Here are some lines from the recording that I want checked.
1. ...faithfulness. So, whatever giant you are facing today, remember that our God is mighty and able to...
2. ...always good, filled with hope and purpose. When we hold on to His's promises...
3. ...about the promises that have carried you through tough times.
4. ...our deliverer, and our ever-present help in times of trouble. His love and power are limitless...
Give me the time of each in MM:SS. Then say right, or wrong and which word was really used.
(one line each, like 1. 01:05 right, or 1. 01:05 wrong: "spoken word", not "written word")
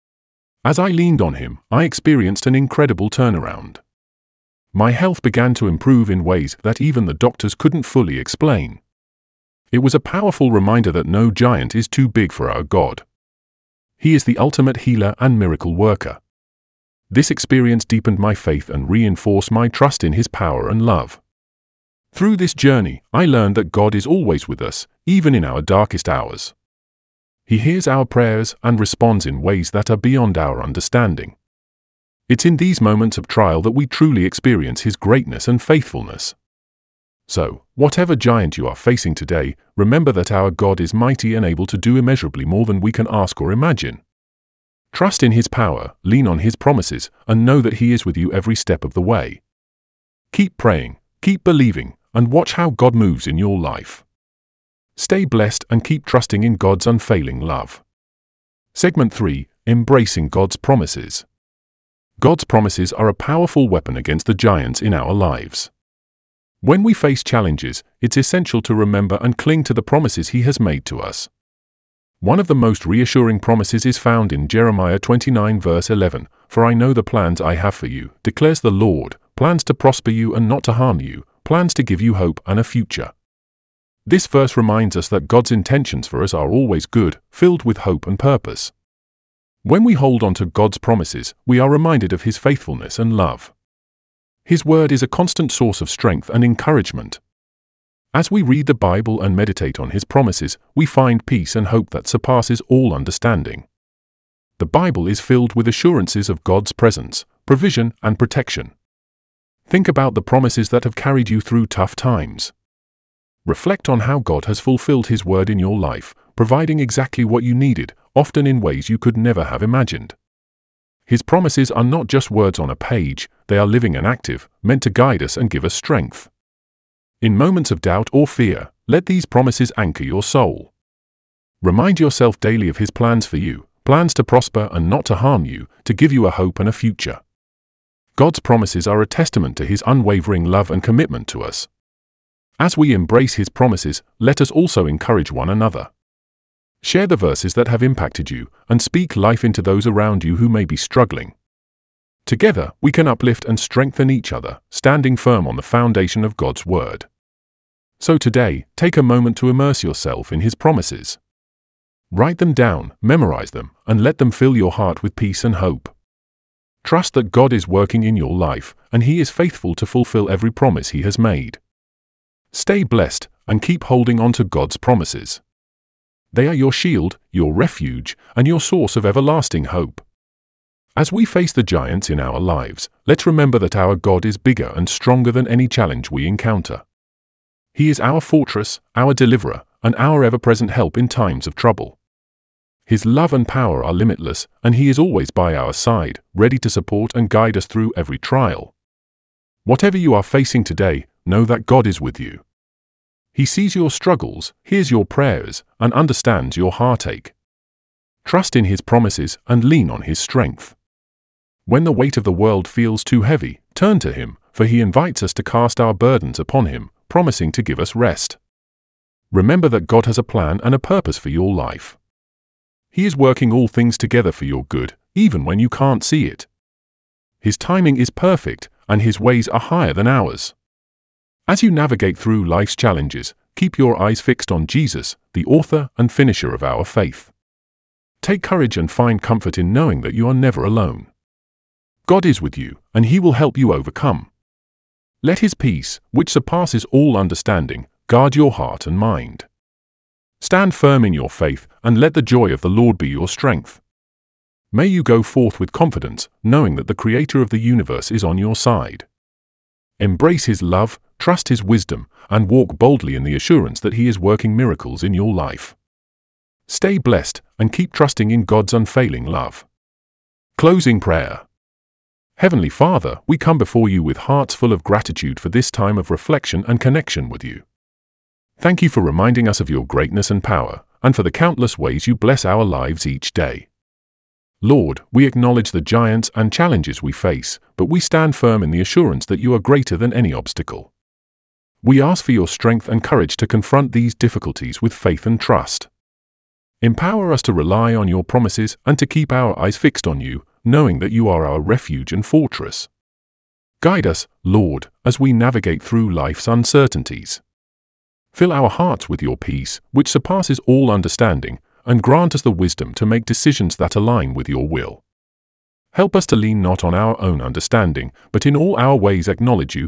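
1. 00:35 right
2. 01:26 wrong: "God", not "His"
3. 01:49 right
4. 03:08 right.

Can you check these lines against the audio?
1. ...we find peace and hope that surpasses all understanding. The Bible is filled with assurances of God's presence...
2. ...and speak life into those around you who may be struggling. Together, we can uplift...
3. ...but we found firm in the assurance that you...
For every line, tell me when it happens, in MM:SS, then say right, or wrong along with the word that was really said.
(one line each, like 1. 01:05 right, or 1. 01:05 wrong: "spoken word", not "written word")
1. 01:40 right
2. 02:28 right
3. 04:47 wrong: "stand", not "found".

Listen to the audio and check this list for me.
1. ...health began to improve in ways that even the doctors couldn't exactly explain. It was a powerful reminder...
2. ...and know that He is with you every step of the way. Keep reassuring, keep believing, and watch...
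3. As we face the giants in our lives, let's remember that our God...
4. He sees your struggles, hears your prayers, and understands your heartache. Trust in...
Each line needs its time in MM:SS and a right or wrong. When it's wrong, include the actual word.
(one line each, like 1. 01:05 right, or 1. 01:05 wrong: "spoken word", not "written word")
1. 00:04 wrong: "fully", not "exactly"
2. 00:47 wrong: "praying", not "reassuring"
3. 03:00 right
4. 03:23 right.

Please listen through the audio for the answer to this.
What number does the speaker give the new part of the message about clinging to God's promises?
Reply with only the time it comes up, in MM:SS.
00:58.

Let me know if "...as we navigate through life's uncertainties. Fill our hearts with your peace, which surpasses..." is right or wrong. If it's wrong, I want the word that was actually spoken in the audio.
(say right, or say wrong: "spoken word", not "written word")
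right.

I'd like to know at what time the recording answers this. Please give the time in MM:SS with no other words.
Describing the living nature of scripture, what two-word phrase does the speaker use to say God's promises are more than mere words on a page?
02:03.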